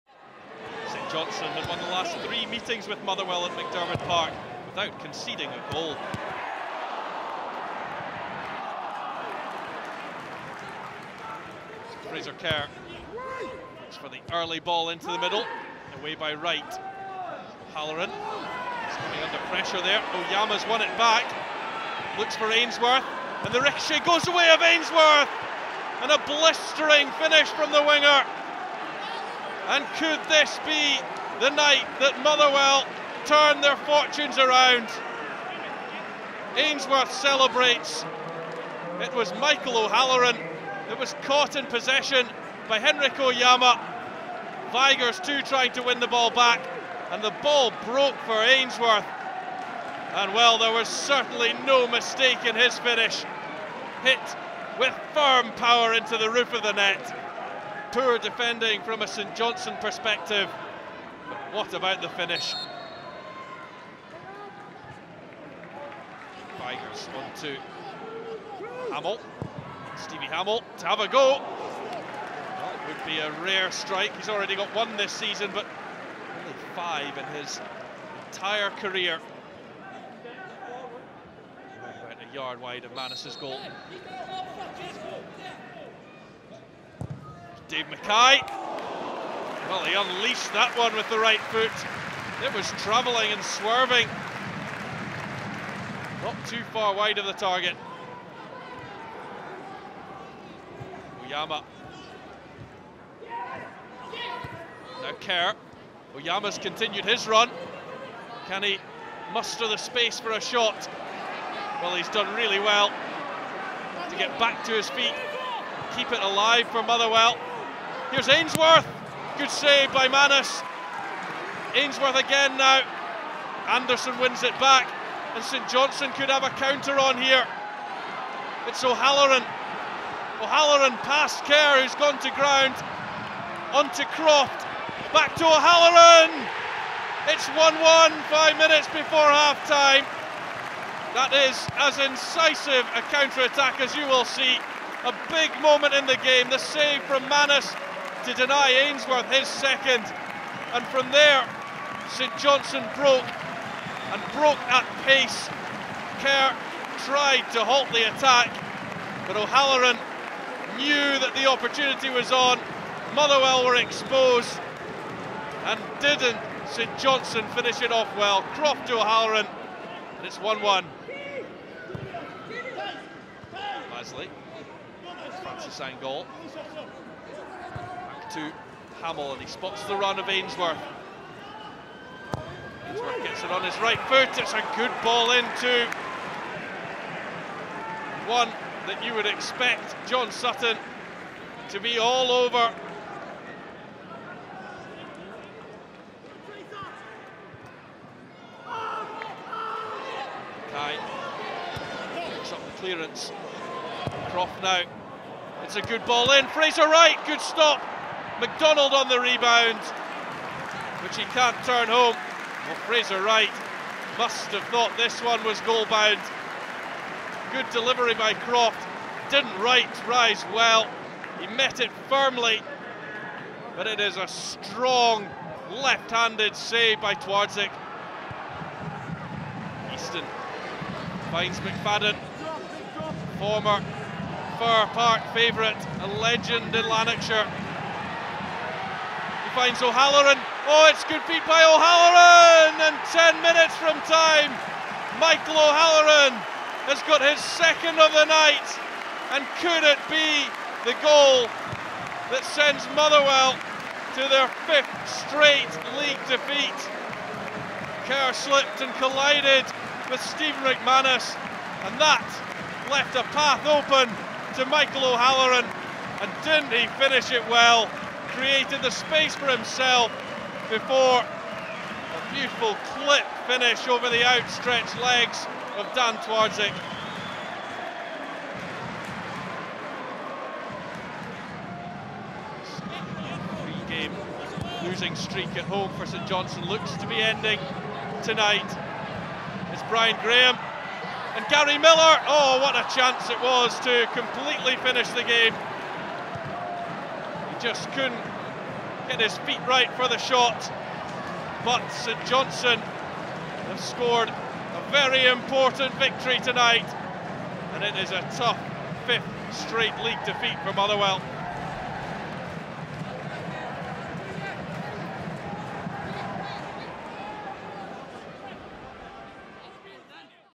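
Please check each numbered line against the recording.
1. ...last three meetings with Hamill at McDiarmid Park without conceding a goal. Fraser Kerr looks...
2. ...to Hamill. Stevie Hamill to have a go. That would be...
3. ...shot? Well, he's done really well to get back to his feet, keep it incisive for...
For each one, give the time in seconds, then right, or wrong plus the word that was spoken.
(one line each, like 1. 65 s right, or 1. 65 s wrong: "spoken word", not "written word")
1. 1 s wrong: "Motherwell", not "Hamill"
2. 67 s right
3. 110 s wrong: "alive", not "incisive".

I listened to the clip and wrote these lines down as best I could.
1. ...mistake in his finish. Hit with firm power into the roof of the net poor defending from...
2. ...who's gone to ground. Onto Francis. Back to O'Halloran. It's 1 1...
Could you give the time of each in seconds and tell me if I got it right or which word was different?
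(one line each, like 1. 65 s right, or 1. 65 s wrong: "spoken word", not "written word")
1. 51 s right
2. 131 s wrong: "Croft", not "Francis".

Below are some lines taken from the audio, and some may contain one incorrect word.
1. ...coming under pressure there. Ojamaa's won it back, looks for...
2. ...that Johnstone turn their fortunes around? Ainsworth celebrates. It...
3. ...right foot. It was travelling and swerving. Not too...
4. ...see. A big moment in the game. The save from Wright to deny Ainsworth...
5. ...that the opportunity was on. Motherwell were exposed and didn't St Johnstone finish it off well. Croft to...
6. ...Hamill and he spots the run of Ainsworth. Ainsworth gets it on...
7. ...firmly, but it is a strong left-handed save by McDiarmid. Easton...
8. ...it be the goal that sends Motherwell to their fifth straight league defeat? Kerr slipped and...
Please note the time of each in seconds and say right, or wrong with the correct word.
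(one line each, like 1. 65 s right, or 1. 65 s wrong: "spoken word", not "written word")
1. 18 s right
2. 31 s wrong: "Motherwell", not "Johnstone"
3. 91 s right
4. 144 s wrong: "Mannus", not "Wright"
5. 161 s right
6. 179 s right
7. 222 s wrong: "Twardzik", not "McDiarmid"
8. 249 s right.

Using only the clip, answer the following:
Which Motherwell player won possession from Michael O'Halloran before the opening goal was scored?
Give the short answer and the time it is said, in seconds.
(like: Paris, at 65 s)
Henrik Ojamaa, at 42 s.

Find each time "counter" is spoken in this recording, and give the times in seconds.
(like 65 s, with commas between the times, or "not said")
126 s, 143 s.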